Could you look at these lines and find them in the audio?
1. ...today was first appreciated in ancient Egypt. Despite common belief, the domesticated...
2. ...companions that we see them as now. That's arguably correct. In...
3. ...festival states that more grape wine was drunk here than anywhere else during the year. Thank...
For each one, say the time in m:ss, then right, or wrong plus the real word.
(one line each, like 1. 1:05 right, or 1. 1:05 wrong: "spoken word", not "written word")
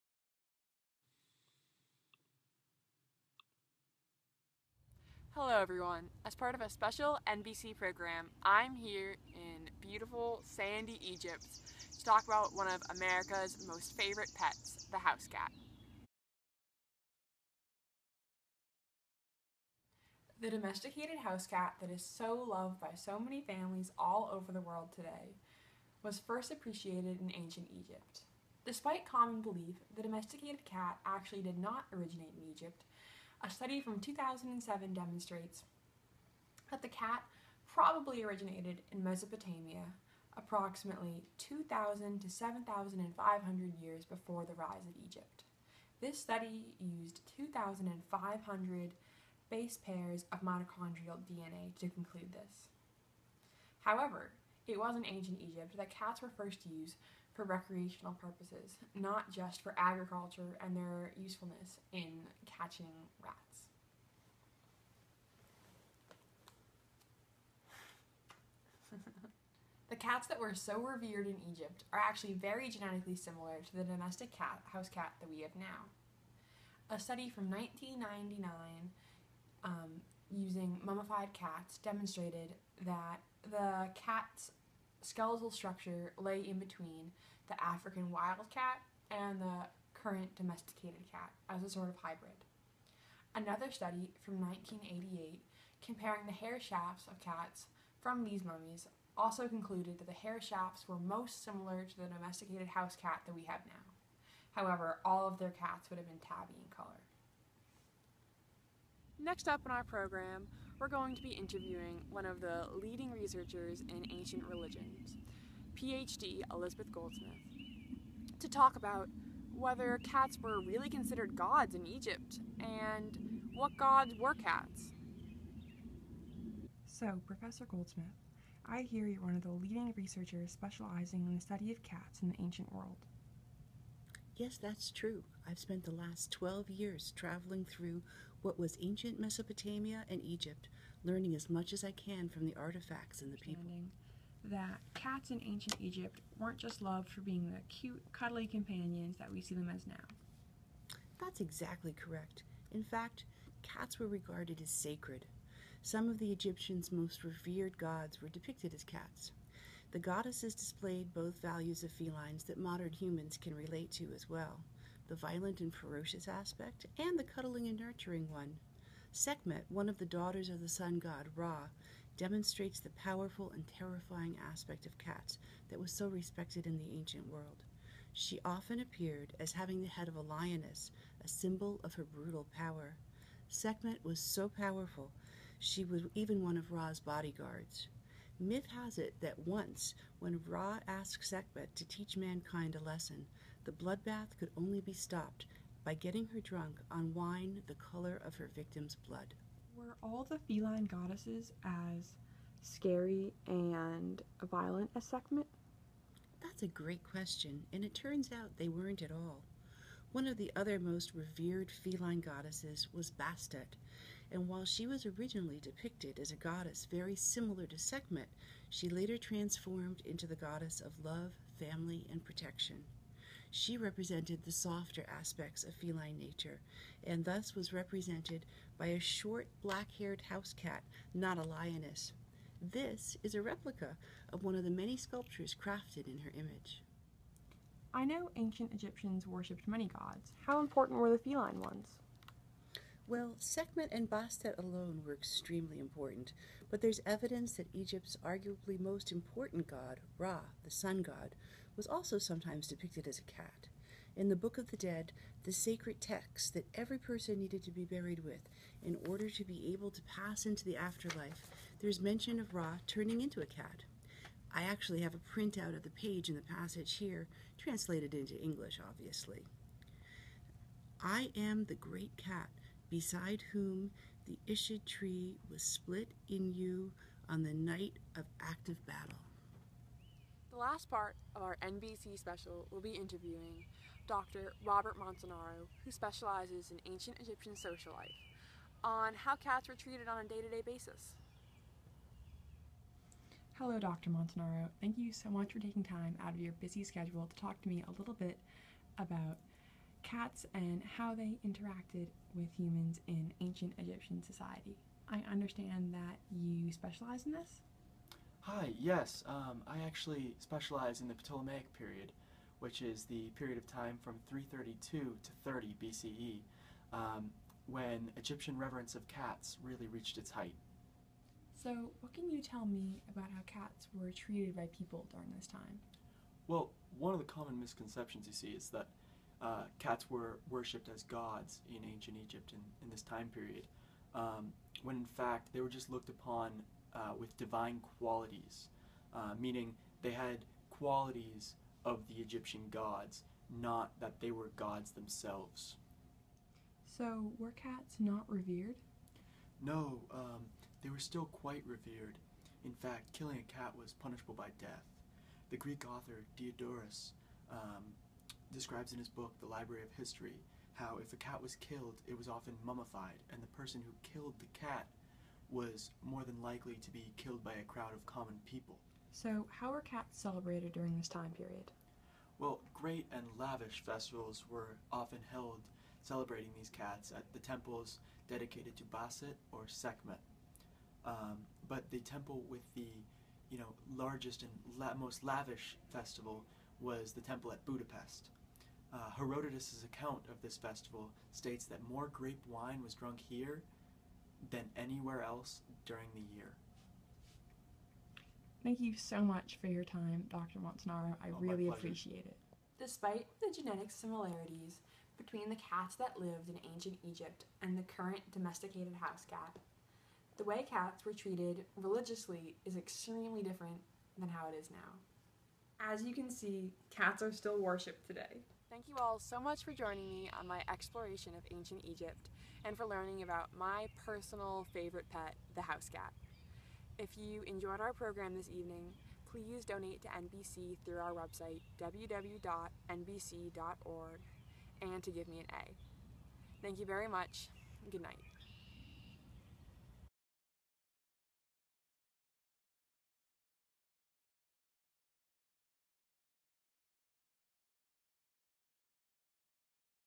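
1. 0:24 right
2. 2:28 wrong: "exactly", not "arguably"
3. 6:30 right.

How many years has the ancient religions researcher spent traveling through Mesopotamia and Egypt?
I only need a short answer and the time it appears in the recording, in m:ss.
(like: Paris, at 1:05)
12, at 2:16.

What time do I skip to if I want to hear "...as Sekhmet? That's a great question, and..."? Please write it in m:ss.
3:24.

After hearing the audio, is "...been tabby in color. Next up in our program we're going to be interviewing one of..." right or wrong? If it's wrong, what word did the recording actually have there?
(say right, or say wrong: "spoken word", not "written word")
right.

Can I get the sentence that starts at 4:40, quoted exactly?
The last part of our NBC special will be interviewing Dr.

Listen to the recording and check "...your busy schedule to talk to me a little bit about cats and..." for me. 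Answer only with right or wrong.
right.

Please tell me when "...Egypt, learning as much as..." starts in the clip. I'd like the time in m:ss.
2:20.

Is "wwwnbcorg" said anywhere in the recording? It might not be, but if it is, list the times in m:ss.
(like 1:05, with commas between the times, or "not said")
7:11.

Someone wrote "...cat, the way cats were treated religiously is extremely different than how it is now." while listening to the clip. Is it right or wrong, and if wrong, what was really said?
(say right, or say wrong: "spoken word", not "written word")
right.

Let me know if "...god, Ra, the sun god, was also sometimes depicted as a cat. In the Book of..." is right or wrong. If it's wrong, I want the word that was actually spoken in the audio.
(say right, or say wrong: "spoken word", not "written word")
right.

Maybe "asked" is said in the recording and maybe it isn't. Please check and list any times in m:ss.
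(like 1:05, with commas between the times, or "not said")
3:10.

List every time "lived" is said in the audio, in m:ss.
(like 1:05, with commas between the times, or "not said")
6:46.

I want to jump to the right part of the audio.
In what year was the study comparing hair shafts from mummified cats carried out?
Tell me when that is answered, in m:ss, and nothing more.
1:34.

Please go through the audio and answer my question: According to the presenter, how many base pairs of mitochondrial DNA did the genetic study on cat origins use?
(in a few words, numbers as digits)
2,500.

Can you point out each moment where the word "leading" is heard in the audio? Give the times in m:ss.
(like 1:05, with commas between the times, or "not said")
1:52, 2:09.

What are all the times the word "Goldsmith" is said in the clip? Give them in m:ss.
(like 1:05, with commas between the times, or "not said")
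1:56, 2:07.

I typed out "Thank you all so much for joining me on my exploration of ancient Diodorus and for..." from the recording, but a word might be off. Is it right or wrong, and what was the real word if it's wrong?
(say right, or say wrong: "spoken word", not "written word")
wrong: "Egypt", not "Diodorus".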